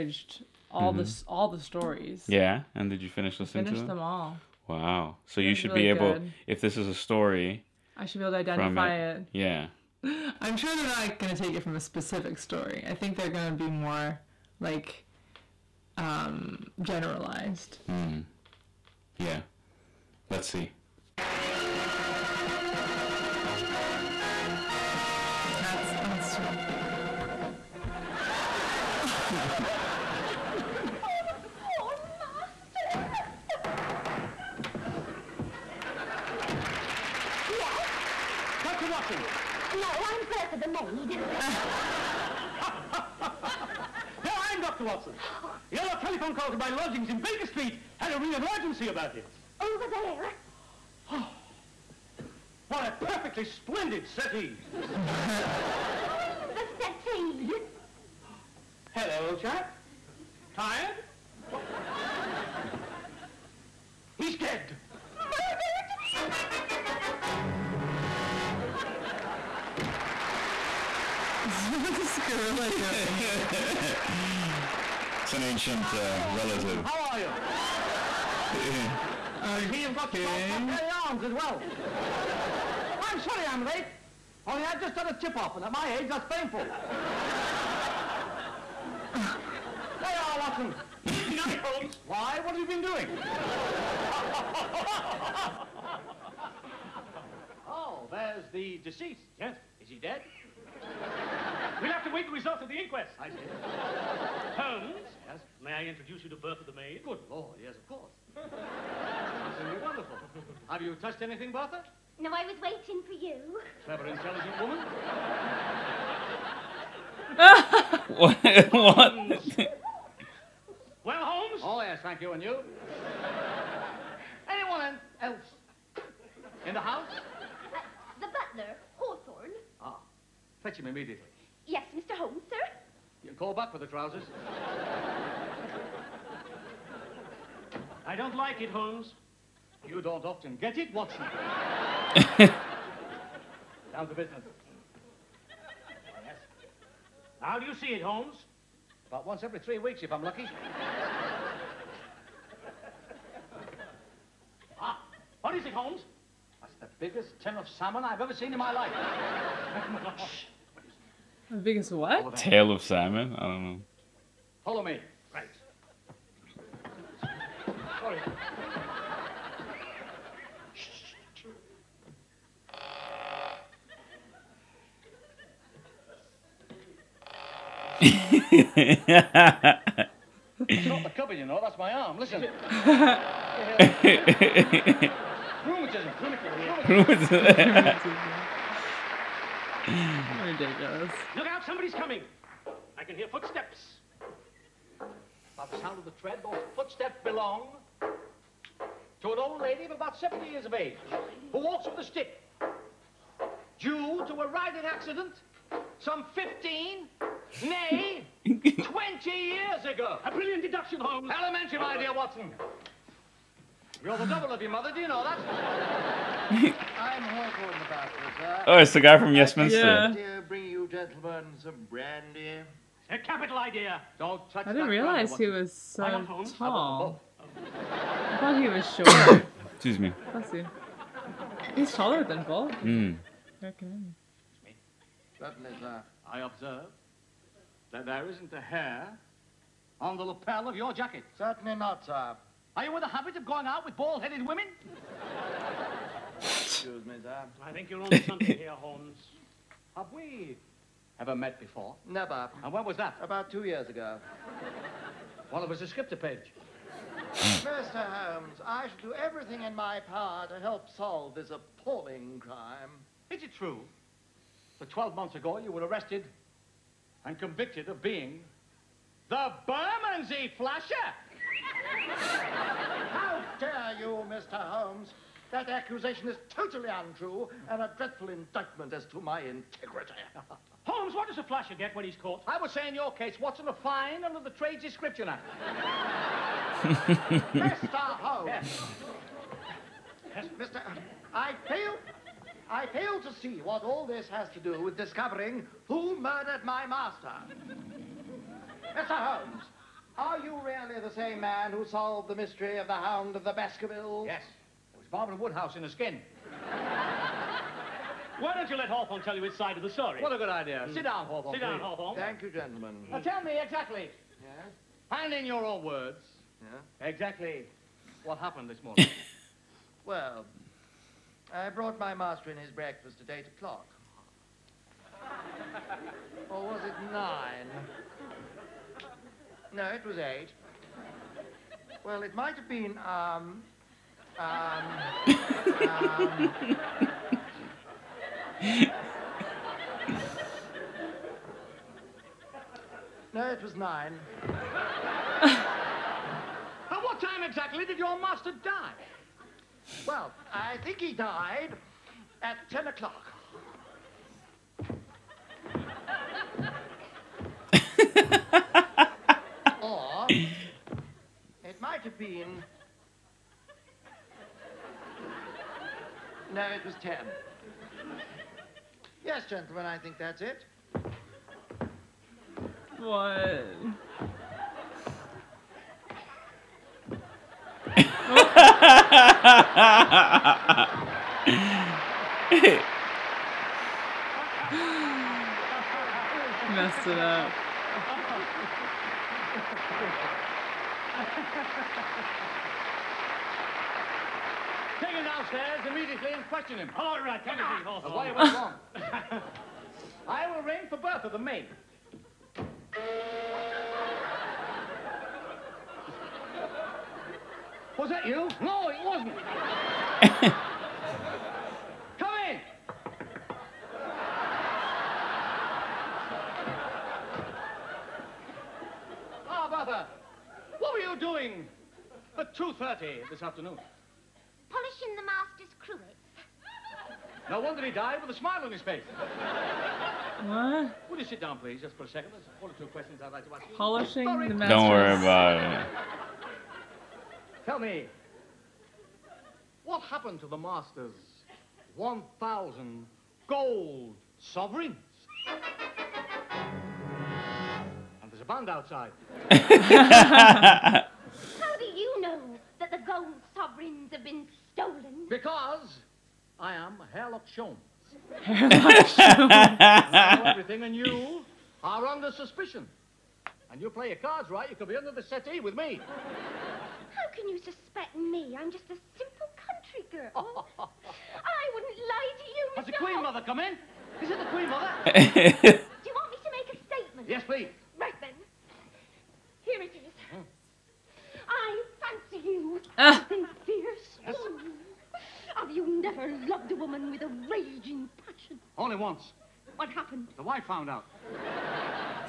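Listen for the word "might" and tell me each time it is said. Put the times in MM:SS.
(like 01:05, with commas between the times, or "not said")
05:32, 06:01.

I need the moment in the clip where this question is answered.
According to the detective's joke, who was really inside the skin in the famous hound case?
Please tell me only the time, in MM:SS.
05:05.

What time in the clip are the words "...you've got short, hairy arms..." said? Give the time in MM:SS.
01:19.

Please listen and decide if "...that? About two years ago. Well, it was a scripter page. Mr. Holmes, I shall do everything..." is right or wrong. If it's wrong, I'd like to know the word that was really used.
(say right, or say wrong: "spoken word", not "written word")
right.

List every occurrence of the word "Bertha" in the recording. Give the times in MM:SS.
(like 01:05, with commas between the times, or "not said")
01:46, 01:51, 06:40.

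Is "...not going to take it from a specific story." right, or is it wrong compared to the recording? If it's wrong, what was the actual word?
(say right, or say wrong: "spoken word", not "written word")
right.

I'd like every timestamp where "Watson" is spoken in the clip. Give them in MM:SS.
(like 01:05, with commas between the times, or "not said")
01:30, 02:20, 03:32.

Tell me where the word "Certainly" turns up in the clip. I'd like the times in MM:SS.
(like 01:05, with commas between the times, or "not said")
03:55, 04:01.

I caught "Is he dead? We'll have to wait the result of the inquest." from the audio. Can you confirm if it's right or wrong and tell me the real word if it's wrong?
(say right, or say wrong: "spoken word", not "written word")
right.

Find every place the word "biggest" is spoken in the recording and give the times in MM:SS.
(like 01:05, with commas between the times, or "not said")
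02:36, 02:41.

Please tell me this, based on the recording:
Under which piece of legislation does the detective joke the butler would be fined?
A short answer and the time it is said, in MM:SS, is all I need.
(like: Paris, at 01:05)
The Trades Description Act, at 04:44.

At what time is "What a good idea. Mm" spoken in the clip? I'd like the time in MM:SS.
05:10.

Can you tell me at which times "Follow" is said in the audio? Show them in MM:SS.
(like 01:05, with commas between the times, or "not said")
02:44.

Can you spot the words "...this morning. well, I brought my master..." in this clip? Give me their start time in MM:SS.
05:18.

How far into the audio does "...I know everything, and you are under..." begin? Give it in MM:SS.
07:39.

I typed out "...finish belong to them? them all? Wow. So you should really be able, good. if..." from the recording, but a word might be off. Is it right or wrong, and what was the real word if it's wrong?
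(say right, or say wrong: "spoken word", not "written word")
wrong: "listening", not "belong".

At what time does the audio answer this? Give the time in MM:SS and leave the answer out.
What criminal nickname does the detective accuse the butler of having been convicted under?
04:29.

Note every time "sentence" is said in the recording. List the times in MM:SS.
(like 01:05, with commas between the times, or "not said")
not said.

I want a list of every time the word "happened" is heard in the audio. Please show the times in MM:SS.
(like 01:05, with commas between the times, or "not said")
05:18, 07:20, 08:09.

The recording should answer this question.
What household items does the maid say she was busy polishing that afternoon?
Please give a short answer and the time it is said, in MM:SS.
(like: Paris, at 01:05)
The master's cruets, at 07:05.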